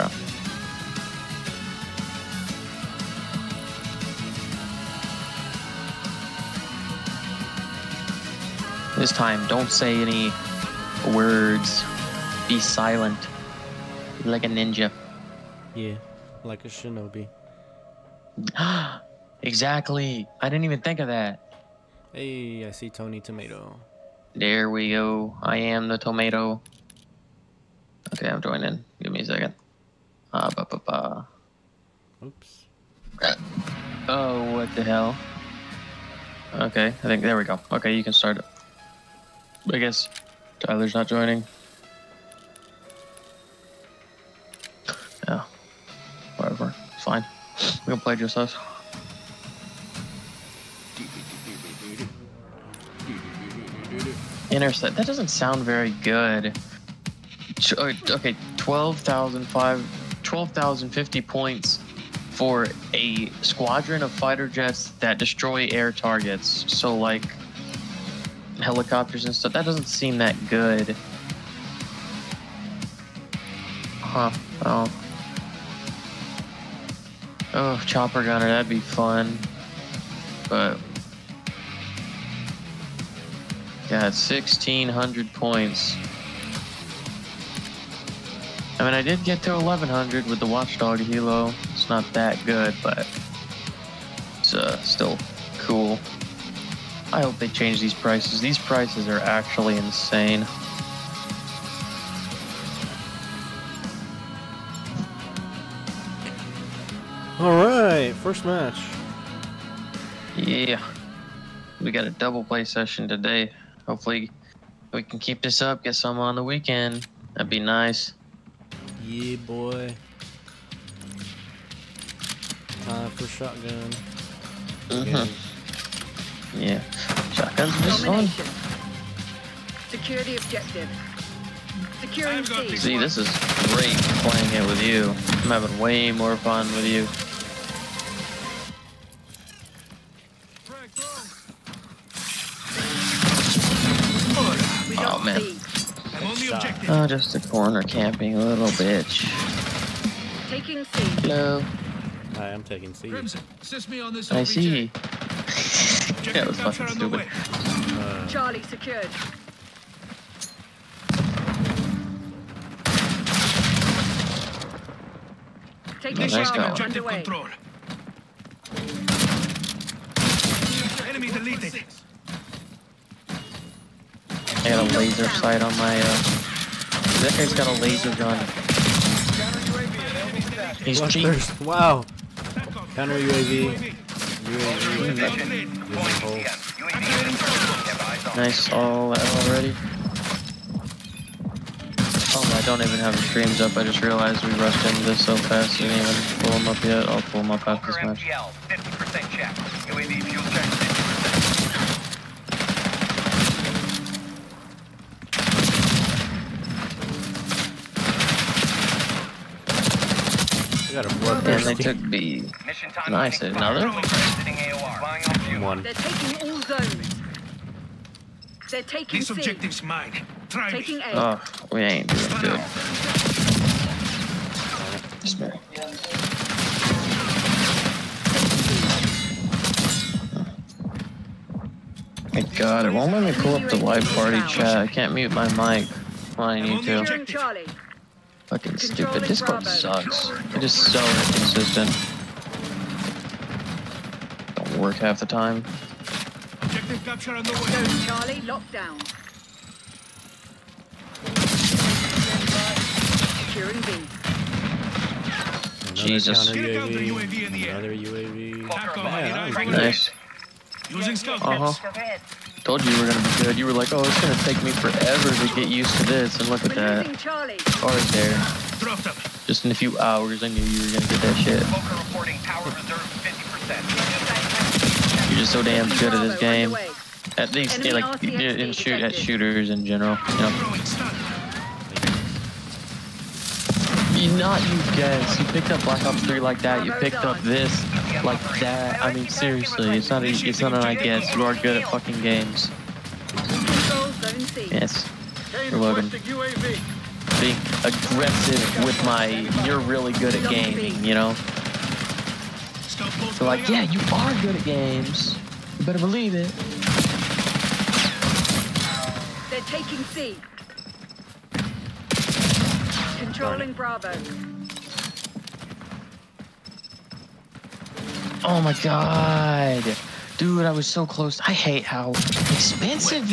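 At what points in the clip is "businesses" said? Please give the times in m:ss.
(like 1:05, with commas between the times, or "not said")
not said.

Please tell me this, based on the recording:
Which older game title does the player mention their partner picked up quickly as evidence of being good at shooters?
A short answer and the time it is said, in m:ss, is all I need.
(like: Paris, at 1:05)
Black Ops 3, at 4:45.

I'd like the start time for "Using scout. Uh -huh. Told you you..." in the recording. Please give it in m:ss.
4:20.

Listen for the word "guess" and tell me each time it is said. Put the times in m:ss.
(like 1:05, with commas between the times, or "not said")
0:39, 4:50.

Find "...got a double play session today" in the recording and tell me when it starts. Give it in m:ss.
1:51.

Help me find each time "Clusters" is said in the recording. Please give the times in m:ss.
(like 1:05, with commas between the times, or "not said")
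3:00.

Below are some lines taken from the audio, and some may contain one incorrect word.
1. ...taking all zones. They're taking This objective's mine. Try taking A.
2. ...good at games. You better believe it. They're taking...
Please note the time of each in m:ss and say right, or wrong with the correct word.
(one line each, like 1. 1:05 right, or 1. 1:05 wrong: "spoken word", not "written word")
1. 3:35 right
2. 5:04 right.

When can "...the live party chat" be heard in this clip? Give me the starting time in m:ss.
3:53.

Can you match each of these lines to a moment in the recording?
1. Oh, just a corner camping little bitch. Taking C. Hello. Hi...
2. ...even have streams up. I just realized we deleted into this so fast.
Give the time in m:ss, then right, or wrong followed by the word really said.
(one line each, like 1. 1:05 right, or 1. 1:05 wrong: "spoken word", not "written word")
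1. 2:26 right
2. 3:12 wrong: "rushed", not "deleted".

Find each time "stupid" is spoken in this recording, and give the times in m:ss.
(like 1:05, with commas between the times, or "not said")
2:36, 3:58.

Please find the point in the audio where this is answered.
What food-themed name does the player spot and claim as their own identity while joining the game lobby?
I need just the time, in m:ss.
0:22.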